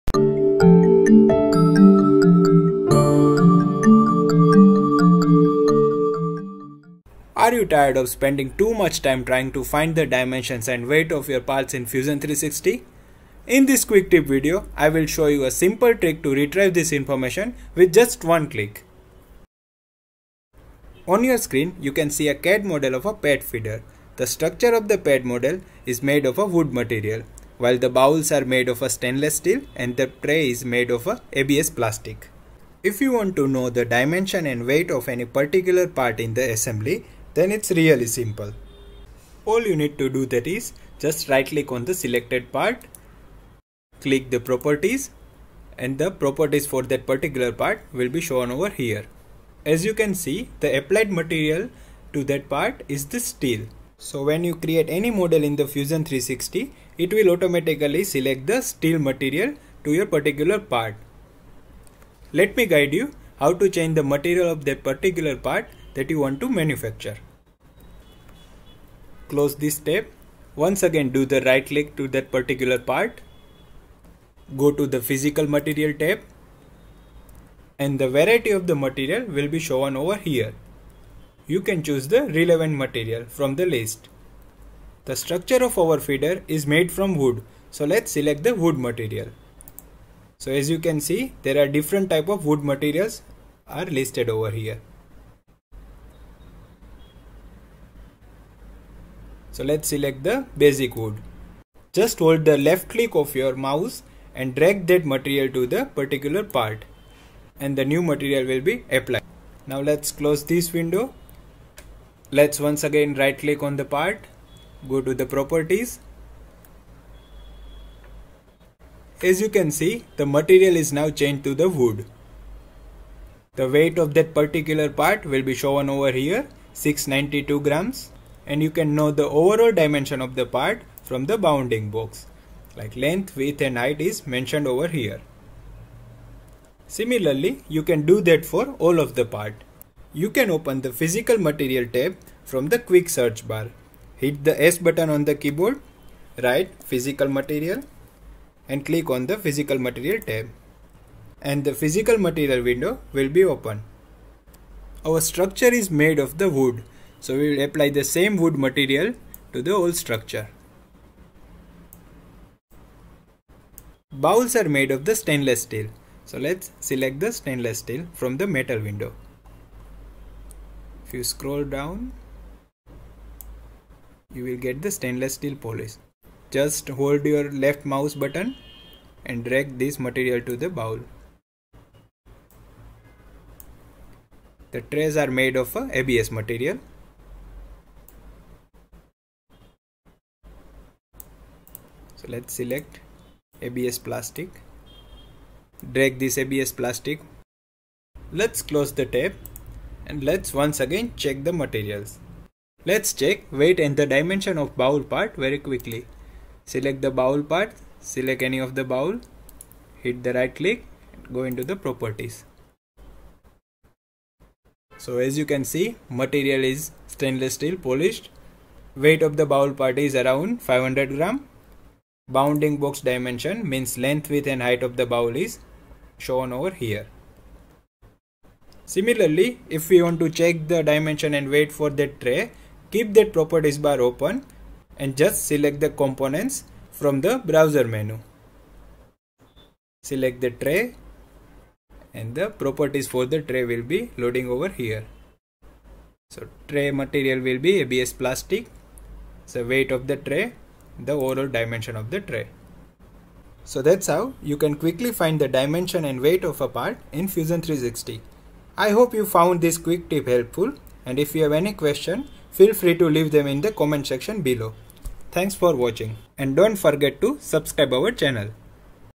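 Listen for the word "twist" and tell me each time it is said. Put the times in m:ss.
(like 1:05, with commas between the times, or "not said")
not said.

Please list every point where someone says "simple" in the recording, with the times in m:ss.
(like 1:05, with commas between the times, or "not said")
0:15, 0:38.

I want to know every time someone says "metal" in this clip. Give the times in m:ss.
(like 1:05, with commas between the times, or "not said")
2:48.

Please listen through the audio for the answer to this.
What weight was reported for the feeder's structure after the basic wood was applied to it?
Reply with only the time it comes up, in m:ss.
2:06.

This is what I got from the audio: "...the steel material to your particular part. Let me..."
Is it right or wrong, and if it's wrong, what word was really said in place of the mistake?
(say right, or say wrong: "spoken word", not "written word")
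right.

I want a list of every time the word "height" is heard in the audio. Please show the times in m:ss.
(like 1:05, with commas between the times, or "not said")
2:13, 3:44.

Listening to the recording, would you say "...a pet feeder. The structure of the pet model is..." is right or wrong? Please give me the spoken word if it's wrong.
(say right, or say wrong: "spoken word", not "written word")
right.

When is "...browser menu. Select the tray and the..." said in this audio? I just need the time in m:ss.
3:57.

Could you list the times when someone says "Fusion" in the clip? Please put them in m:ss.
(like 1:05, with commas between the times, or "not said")
0:11, 0:55, 4:17.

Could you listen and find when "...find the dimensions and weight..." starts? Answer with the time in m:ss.
0:09.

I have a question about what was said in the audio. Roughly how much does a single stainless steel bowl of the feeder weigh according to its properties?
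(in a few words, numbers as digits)
500 grams.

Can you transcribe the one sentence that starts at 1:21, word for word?
You can choose the relevant material from the list.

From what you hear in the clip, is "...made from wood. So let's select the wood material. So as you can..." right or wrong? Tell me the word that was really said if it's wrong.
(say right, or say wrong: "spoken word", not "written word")
right.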